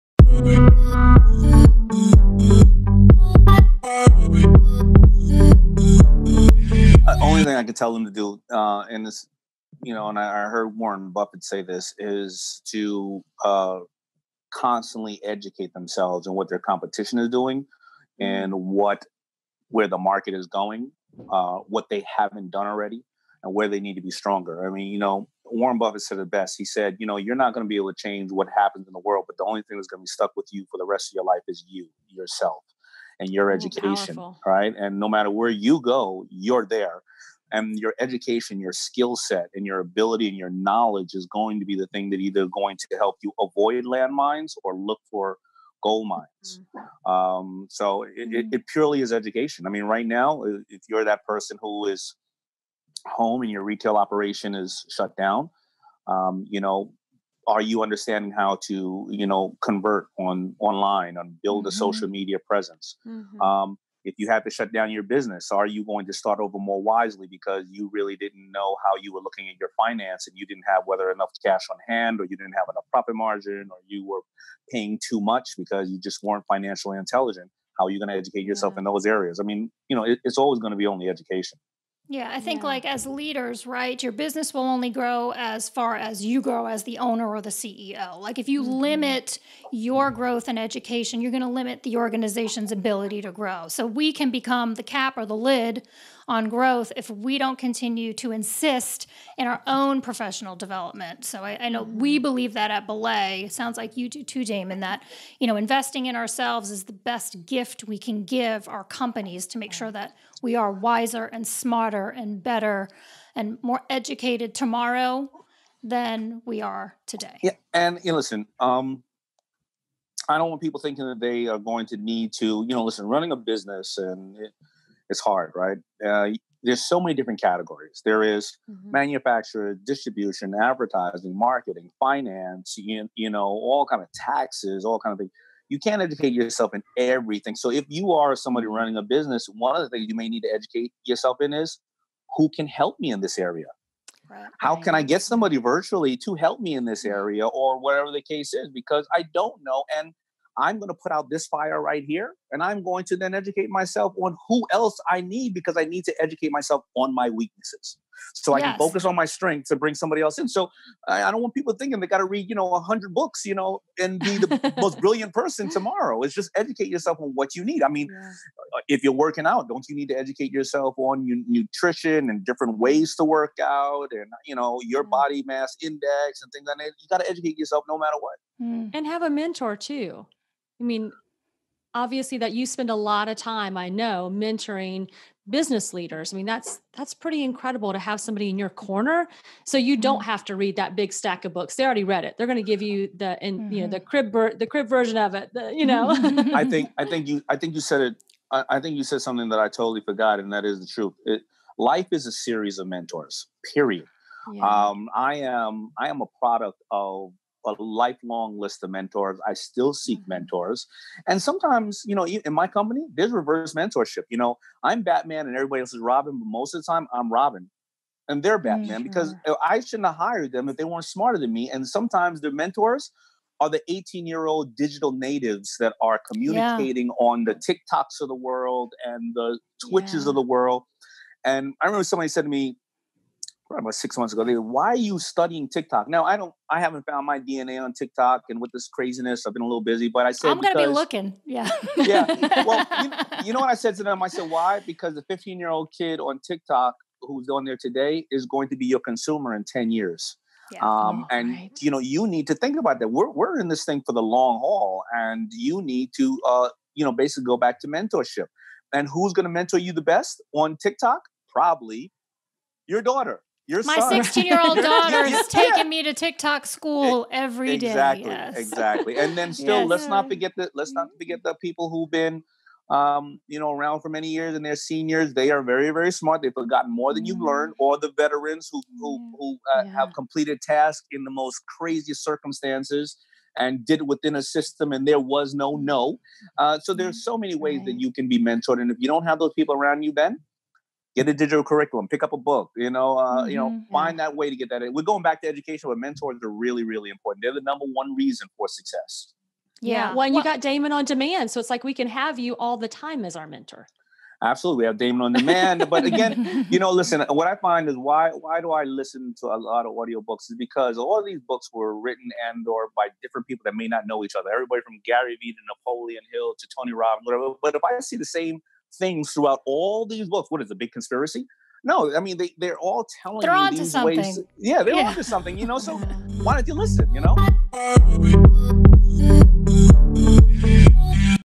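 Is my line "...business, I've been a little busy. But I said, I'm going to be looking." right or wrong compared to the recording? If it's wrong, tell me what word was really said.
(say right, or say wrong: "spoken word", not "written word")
wrong: "craziness", not "business".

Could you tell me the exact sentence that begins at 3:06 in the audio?
I mean, that's that's pretty incredible to have somebody in your corner.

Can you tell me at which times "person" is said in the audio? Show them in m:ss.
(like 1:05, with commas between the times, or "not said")
0:51, 2:45.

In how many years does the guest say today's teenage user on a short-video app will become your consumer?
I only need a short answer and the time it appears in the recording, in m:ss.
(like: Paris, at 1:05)
10, at 4:09.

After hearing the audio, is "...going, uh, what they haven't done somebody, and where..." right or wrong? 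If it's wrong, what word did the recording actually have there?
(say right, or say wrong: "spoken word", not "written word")
wrong: "already", not "somebody".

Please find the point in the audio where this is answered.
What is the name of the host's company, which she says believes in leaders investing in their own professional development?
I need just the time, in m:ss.
1:42.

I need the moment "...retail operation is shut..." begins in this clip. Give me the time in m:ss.
0:53.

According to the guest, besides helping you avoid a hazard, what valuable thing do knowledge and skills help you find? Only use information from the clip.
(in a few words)
gold mines.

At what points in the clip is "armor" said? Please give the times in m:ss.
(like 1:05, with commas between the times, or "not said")
not said.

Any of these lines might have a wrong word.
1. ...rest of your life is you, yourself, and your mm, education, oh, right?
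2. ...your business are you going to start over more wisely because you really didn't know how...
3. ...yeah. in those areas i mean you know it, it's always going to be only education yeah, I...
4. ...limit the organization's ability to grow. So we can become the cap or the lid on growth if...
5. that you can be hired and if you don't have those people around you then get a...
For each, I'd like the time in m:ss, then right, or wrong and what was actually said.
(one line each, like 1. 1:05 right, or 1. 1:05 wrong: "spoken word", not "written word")
1. 0:30 right
2. 1:04 right
3. 1:18 right
4. 1:31 right
5. 4:47 wrong: "mentored", not "hired".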